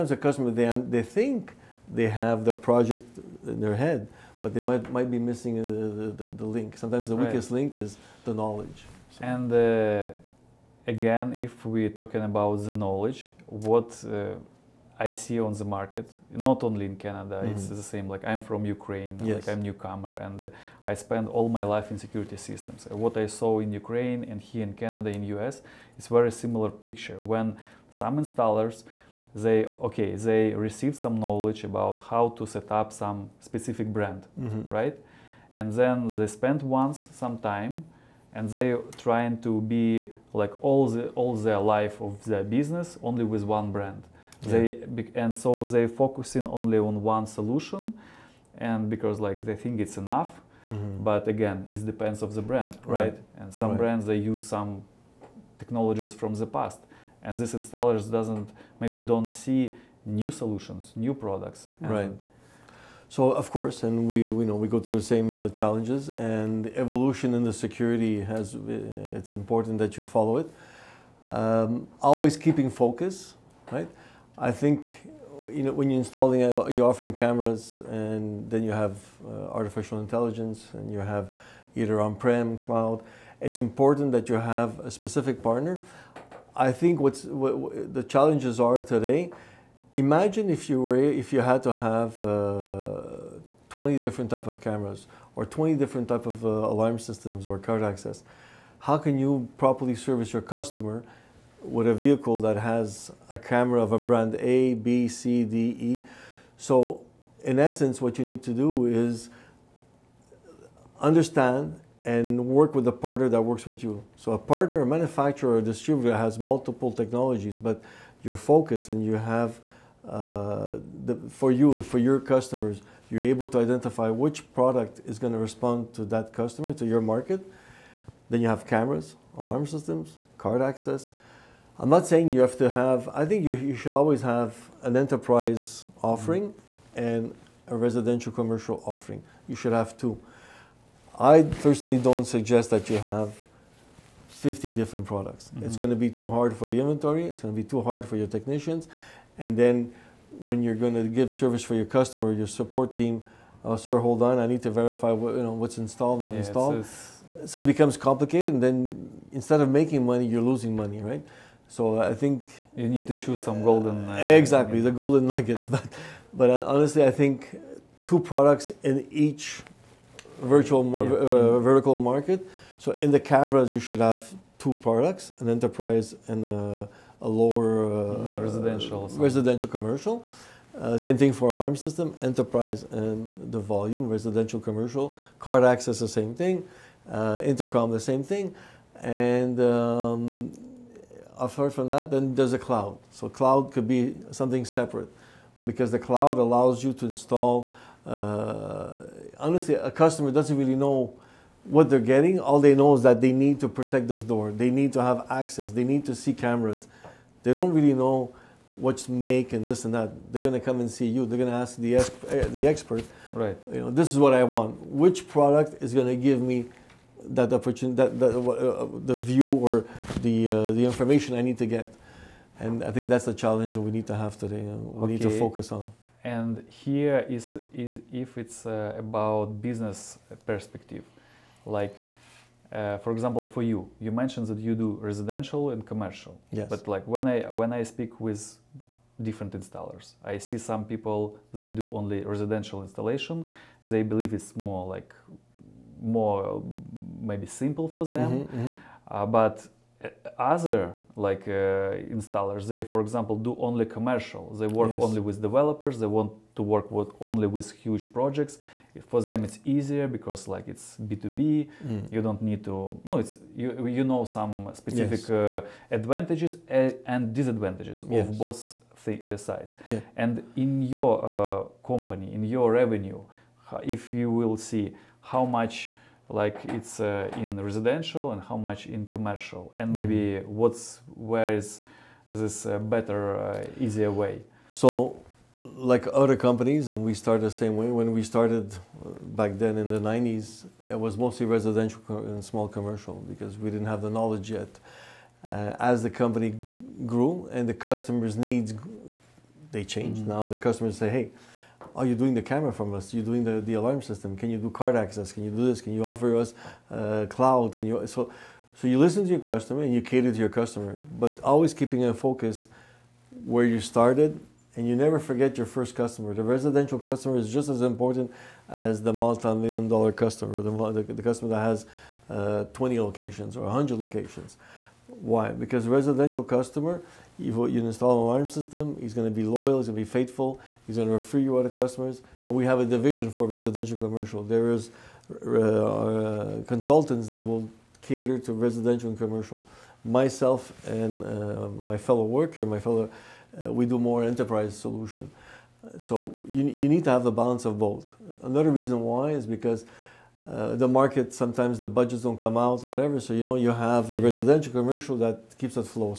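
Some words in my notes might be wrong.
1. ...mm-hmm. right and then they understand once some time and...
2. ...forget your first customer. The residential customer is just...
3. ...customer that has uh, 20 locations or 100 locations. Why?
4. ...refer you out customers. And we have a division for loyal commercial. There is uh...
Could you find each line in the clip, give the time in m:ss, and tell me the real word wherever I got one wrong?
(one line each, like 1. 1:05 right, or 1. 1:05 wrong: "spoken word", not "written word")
1. 0:34 wrong: "spend", not "understand"
2. 5:15 right
3. 5:21 right
4. 5:31 wrong: "residential", not "loyal".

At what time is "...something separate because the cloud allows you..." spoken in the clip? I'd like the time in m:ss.
3:14.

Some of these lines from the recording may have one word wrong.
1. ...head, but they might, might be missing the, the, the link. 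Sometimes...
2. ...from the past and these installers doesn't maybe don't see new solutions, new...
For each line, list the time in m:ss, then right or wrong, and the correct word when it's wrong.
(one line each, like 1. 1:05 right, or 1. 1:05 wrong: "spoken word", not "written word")
1. 0:03 right
2. 0:56 right.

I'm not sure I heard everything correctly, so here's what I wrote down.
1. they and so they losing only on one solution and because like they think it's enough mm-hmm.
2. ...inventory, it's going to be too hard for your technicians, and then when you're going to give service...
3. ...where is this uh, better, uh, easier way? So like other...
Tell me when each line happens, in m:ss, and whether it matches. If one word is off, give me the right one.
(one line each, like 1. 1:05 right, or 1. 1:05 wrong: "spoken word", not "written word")
1. 0:44 wrong: "focusing", not "losing"
2. 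2:26 right
3. 4:41 right.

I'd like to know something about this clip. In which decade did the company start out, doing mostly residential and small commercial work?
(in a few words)
1990s.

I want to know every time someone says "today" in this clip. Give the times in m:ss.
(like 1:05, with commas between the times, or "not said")
1:28, 3:44.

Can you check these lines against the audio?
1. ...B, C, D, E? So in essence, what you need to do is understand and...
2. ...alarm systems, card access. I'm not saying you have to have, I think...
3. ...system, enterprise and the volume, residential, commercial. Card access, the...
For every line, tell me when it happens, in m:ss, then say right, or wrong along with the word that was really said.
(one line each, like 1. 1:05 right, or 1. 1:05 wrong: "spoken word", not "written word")
1. 1:44 right
2. 2:09 right
3. 3:01 right.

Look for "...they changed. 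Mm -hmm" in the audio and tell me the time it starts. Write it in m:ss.
4:59.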